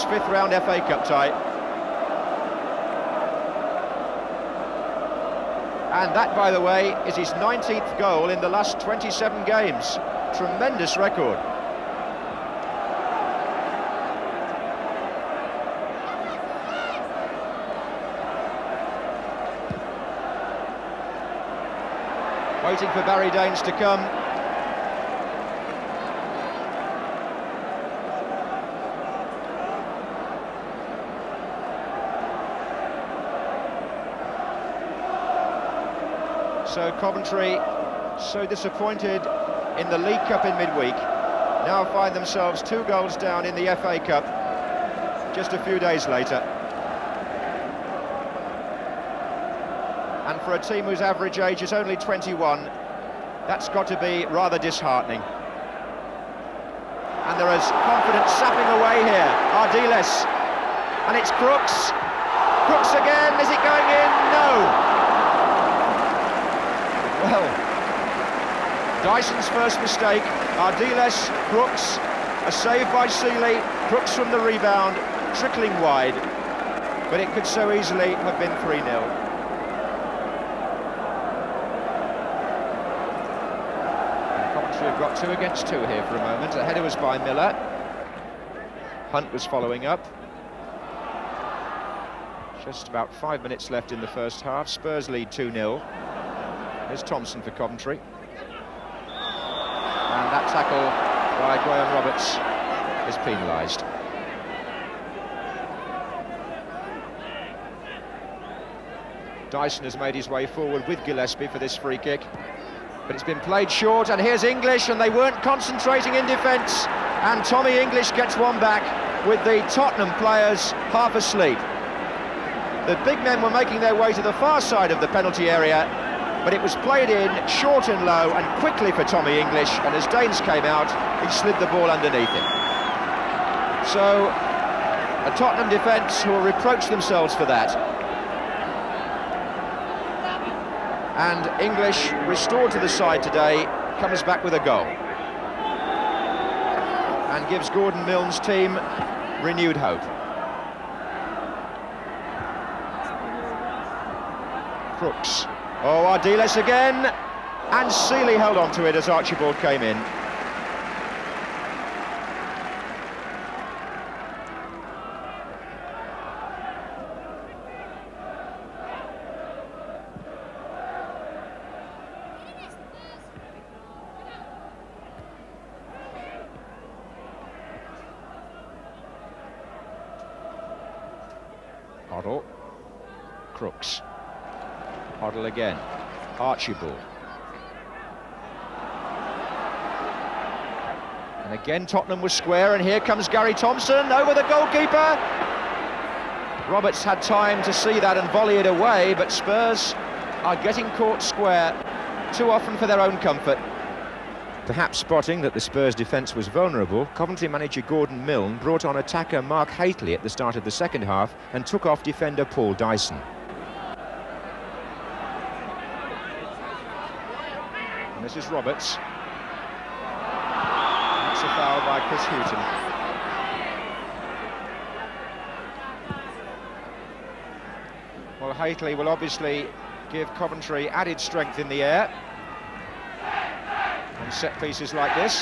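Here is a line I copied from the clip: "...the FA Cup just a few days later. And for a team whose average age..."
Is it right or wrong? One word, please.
right.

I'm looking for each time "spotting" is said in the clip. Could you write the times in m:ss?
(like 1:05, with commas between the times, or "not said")
3:24.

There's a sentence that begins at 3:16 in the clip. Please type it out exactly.
Roberts had time to see that and volley it away, but Spurs are getting caught square too often for their own comfort.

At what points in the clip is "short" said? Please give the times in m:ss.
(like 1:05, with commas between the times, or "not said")
1:53, 2:07.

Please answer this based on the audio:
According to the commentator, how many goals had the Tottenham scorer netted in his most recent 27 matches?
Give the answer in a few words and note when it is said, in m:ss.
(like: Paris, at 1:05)
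19, at 0:07.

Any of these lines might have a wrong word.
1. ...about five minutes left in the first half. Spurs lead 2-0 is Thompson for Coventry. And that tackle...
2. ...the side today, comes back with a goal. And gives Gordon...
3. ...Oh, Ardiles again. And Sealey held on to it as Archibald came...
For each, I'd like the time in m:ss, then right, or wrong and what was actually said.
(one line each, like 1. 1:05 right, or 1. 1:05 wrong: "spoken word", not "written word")
1. 1:32 right
2. 2:22 right
3. 2:35 right.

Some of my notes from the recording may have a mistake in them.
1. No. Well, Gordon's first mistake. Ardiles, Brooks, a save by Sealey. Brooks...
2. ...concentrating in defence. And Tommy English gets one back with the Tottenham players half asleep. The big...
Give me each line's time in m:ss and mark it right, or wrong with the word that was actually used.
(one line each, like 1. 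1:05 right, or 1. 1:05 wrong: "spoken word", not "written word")
1. 1:04 wrong: "Dyson", not "Gordon"
2. 1:55 right.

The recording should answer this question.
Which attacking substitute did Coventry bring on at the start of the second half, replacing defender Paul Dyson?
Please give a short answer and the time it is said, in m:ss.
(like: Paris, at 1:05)
Mark Hateley, at 3:29.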